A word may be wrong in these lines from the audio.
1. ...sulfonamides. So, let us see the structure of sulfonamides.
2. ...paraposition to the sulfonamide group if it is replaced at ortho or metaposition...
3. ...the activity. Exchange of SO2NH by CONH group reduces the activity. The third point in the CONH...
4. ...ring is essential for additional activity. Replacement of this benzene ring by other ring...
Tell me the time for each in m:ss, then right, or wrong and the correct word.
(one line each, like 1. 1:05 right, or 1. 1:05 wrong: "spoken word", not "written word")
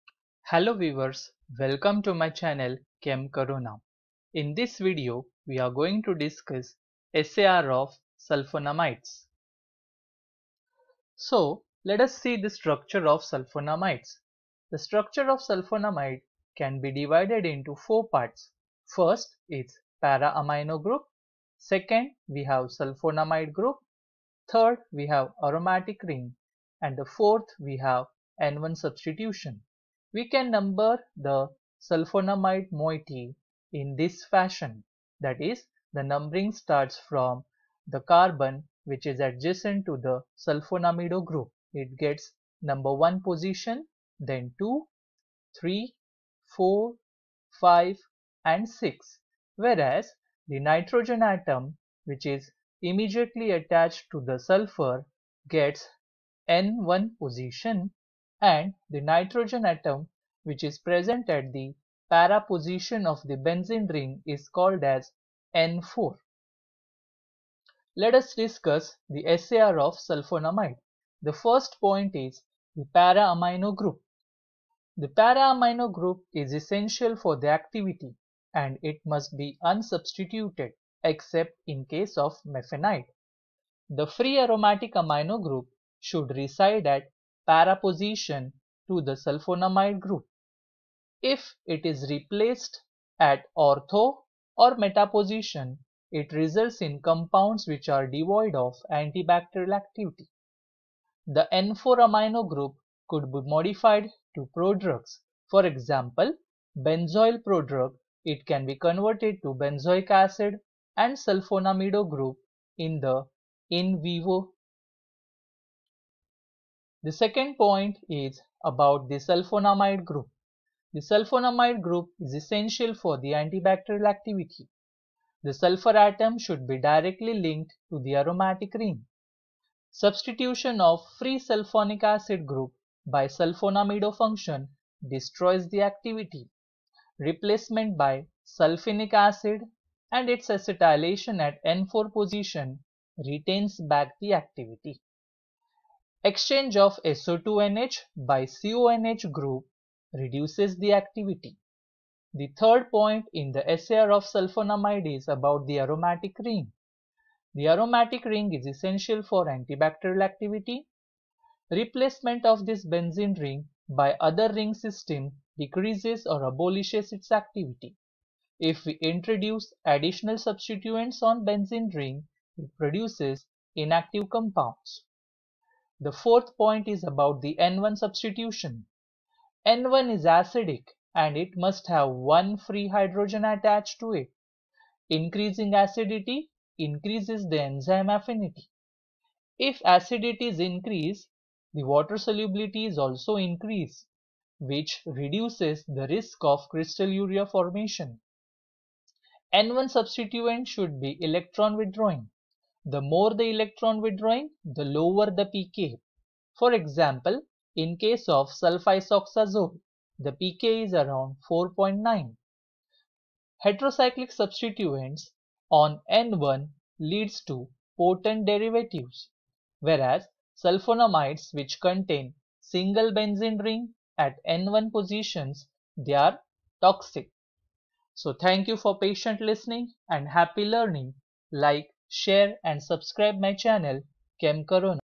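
1. 0:08 right
2. 1:27 right
3. 2:24 wrong: "SAR", not "CONH"
4. 2:38 wrong: "antibacterial", not "additional".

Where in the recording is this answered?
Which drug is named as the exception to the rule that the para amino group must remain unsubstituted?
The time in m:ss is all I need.
1:22.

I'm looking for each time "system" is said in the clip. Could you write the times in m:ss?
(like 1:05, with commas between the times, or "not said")
2:44.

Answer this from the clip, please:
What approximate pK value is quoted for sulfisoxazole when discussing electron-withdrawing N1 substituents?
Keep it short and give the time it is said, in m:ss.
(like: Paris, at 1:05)
4.9, at 3:31.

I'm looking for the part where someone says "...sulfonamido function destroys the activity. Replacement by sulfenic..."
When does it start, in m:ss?
2:13.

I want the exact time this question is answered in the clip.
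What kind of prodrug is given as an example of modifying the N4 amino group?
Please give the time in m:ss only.
1:46.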